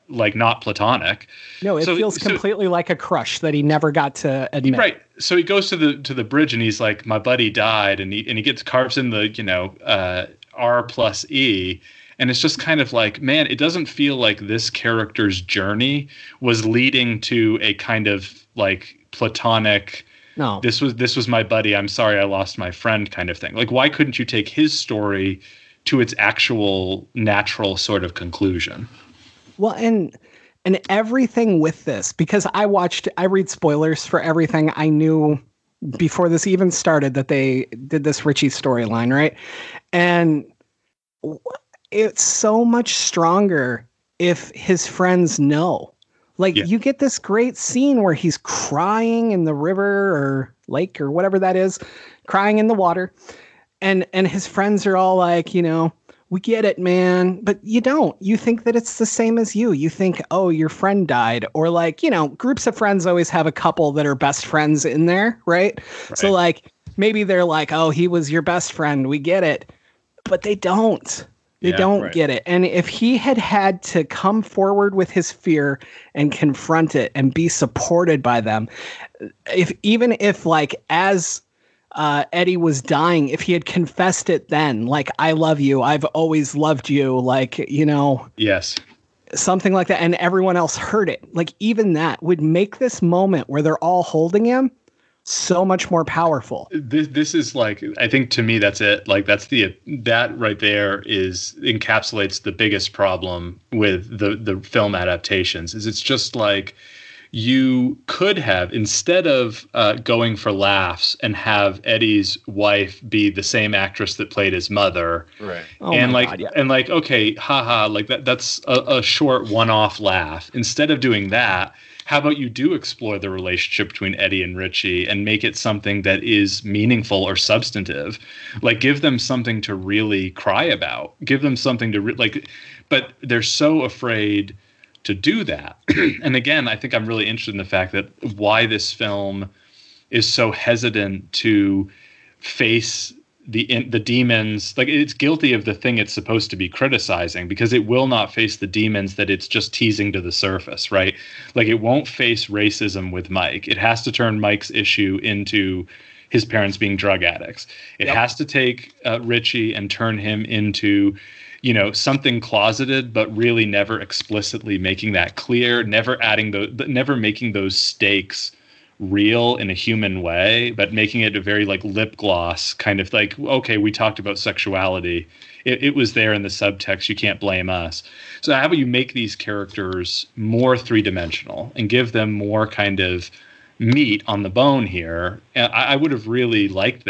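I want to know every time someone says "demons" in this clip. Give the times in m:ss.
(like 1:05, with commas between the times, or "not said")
2:23, 2:28.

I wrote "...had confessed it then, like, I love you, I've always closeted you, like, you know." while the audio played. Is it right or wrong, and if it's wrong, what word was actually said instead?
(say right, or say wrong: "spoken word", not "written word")
wrong: "loved", not "closeted".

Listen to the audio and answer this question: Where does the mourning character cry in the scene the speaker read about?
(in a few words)
in the water.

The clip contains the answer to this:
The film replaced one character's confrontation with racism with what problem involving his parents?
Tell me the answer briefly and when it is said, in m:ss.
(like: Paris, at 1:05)
drug addicts, at 2:36.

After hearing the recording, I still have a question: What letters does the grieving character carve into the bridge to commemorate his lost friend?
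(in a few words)
R plus E.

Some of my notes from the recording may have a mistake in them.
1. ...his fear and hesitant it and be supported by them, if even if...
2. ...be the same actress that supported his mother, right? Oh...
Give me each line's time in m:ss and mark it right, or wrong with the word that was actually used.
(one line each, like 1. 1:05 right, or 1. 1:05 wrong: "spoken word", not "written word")
1. 1:15 wrong: "confront", not "hesitant"
2. 1:53 wrong: "played", not "supported".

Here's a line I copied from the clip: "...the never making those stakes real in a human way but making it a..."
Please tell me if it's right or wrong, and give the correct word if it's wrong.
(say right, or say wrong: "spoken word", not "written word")
right.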